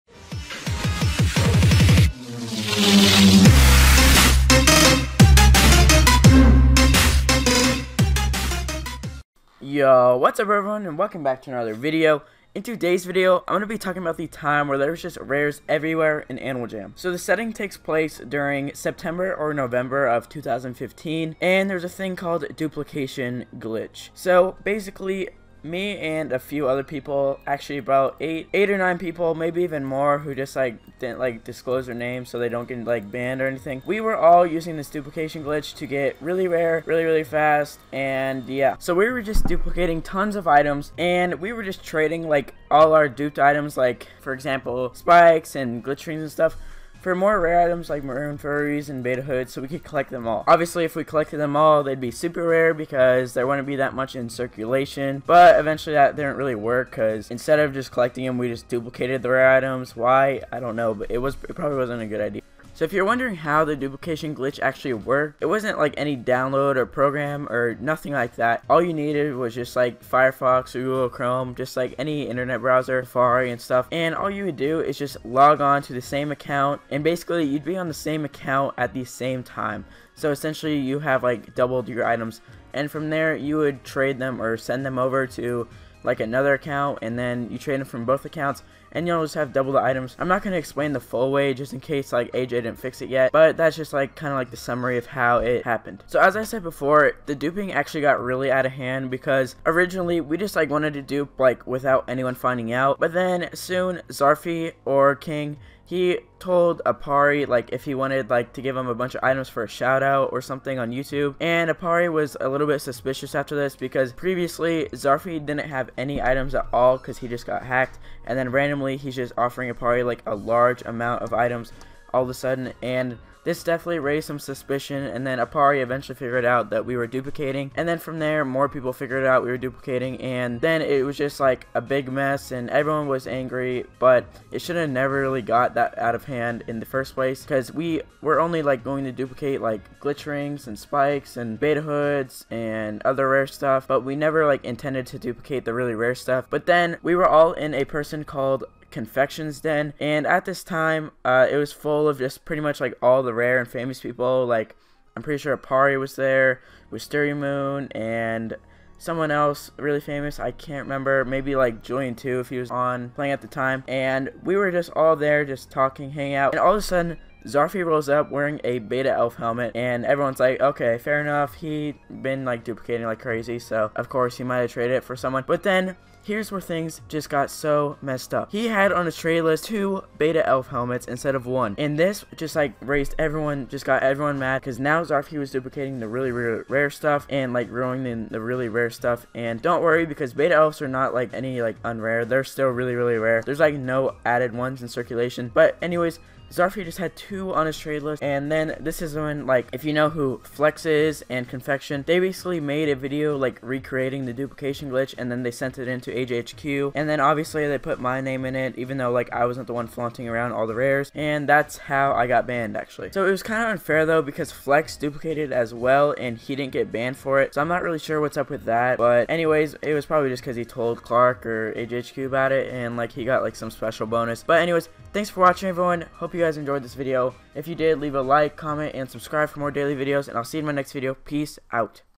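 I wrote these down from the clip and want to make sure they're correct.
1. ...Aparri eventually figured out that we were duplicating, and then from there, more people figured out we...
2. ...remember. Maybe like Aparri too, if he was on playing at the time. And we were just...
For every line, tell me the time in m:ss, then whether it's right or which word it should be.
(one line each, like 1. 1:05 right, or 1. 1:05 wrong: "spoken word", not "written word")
1. 2:05 right
2. 2:40 wrong: "Julian", not "Aparri".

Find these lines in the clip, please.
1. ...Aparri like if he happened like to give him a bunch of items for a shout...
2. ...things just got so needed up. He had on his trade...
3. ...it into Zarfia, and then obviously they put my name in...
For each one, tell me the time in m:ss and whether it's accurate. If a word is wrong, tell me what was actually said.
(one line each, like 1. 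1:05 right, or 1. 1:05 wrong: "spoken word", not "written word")
1. 1:46 wrong: "wanted", not "happened"
2. 2:56 wrong: "messed", not "needed"
3. 3:25 wrong: "AJHQ", not "Zarfia".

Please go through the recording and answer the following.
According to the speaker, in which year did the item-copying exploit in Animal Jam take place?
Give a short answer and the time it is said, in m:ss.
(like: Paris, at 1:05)
2015, at 0:20.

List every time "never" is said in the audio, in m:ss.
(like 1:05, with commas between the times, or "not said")
2:14, 2:24.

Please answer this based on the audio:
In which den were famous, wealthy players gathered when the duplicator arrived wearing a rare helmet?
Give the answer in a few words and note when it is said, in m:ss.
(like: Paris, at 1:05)
Confections Den, at 2:28.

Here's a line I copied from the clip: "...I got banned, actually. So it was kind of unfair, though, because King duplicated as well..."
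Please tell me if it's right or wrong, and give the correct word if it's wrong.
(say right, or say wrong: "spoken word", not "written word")
wrong: "Flex", not "King".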